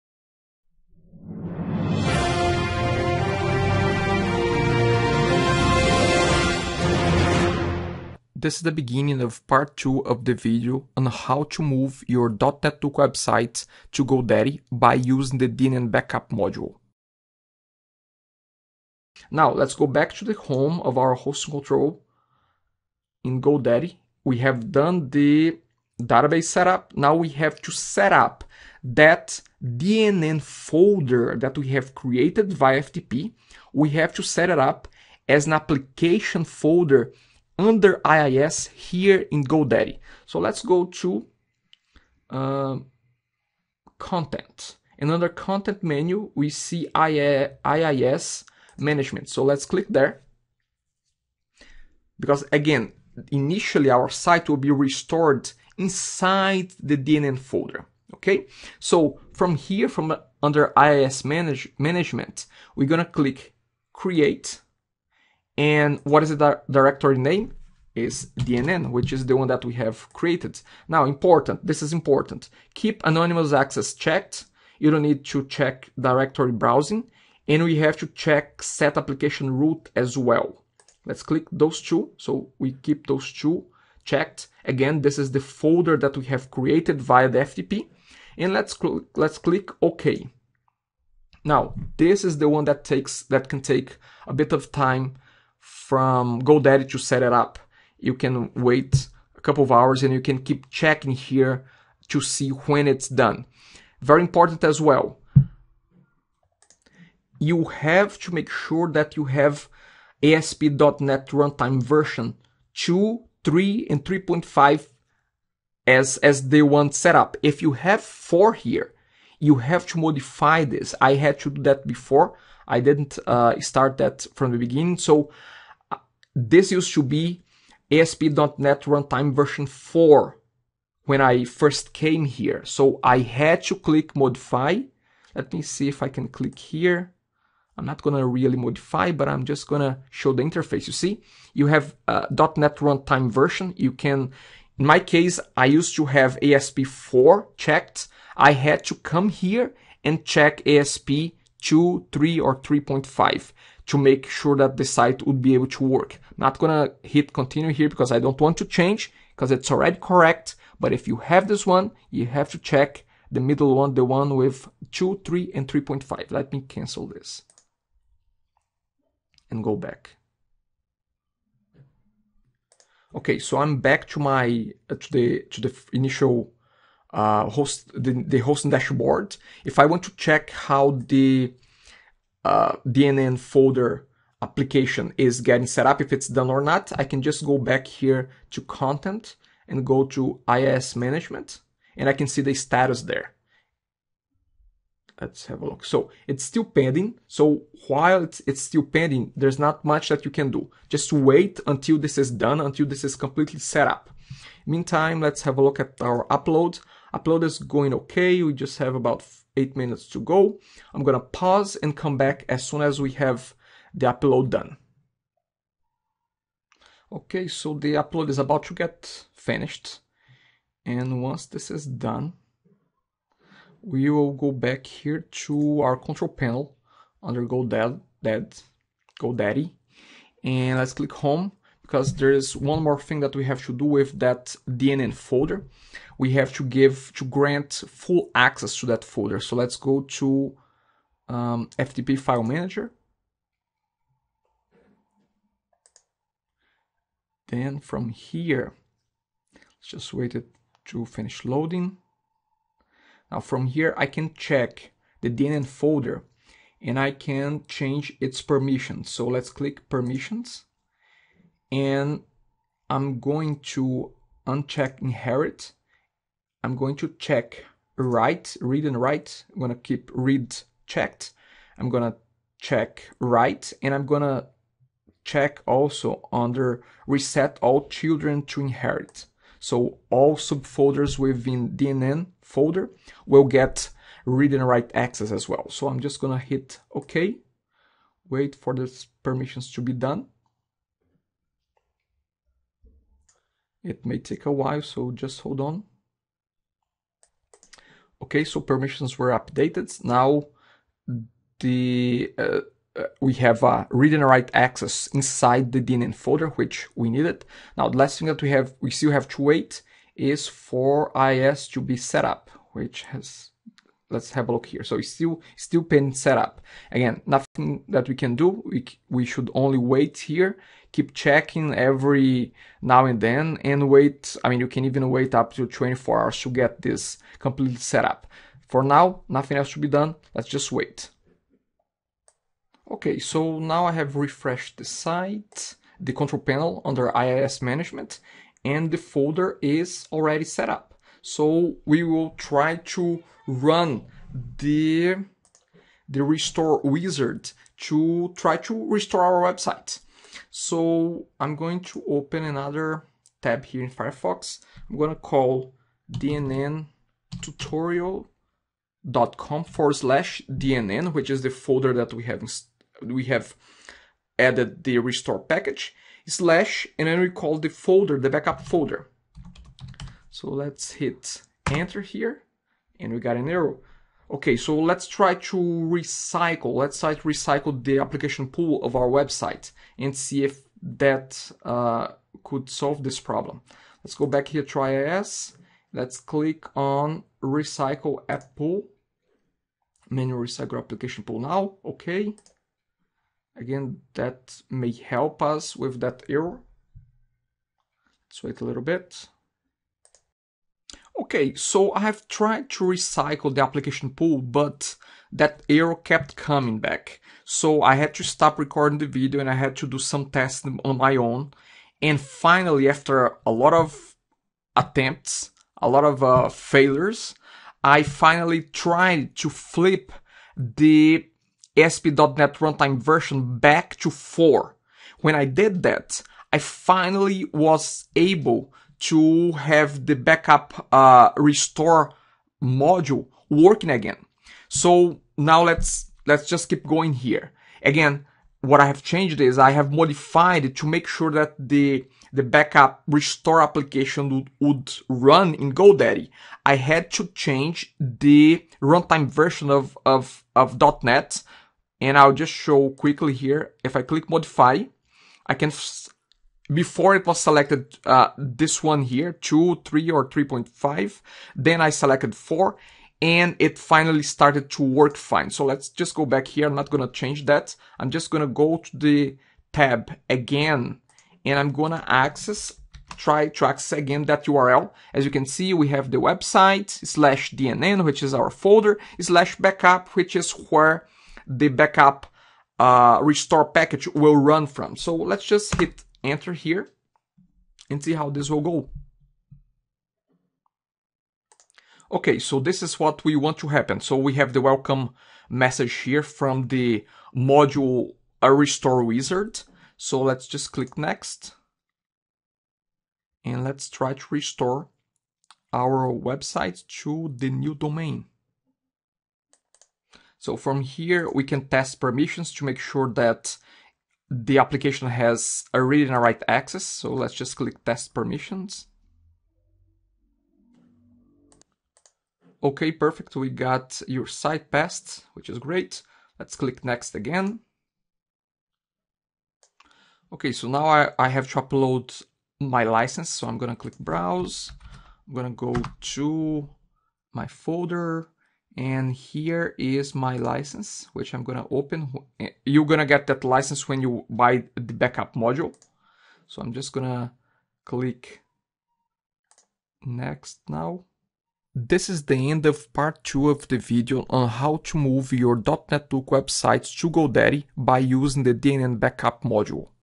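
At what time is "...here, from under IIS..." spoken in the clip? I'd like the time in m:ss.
0:59.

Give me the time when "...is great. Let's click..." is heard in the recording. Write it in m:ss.
8:45.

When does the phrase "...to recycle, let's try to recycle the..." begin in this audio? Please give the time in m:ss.
6:15.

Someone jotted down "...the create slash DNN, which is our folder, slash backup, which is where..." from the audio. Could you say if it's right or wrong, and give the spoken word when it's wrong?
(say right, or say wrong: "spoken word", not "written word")
wrong: "website", not "create".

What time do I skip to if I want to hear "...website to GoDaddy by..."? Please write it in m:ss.
0:12.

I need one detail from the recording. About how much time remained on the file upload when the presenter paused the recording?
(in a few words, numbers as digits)
8 minutes.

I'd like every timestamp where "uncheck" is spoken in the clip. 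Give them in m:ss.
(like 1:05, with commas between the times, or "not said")
4:24.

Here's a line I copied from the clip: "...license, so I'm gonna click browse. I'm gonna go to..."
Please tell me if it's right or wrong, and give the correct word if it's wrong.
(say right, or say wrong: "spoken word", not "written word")
right.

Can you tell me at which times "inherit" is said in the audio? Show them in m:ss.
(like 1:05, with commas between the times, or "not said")
4:25, 4:38.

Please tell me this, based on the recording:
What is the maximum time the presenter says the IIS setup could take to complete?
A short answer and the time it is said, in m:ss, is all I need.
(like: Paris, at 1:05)
24 hours, at 5:25.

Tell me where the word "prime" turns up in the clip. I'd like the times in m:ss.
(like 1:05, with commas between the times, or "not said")
not said.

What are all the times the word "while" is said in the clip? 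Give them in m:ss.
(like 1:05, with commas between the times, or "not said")
3:17, 4:54.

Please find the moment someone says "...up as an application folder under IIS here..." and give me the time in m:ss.
0:34.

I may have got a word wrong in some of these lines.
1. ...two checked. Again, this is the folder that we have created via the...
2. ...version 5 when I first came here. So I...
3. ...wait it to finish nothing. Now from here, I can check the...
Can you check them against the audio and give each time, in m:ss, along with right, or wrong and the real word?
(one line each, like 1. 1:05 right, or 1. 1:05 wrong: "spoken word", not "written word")
1. 1:23 right
2. 2:09 wrong: "4", not "5"
3. 4:10 wrong: "loading", not "nothing".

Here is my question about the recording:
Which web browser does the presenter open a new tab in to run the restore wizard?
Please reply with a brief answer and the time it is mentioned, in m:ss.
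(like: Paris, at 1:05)
Firefox, at 5:53.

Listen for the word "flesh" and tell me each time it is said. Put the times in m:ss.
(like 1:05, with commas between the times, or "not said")
not said.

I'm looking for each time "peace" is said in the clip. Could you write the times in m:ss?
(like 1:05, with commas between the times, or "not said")
not said.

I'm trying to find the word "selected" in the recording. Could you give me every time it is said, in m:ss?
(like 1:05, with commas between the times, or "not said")
7:37, 7:41.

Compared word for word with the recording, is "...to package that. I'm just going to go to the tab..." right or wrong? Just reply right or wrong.
wrong.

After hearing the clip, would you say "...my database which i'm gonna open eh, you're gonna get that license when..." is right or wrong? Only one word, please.
wrong.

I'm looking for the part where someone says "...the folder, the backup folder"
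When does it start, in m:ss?
6:07.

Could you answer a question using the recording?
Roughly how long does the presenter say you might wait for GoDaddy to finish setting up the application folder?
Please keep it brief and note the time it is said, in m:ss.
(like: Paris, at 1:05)
A couple of hours, at 1:39.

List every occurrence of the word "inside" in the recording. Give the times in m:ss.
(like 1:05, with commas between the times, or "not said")
0:55, 5:05.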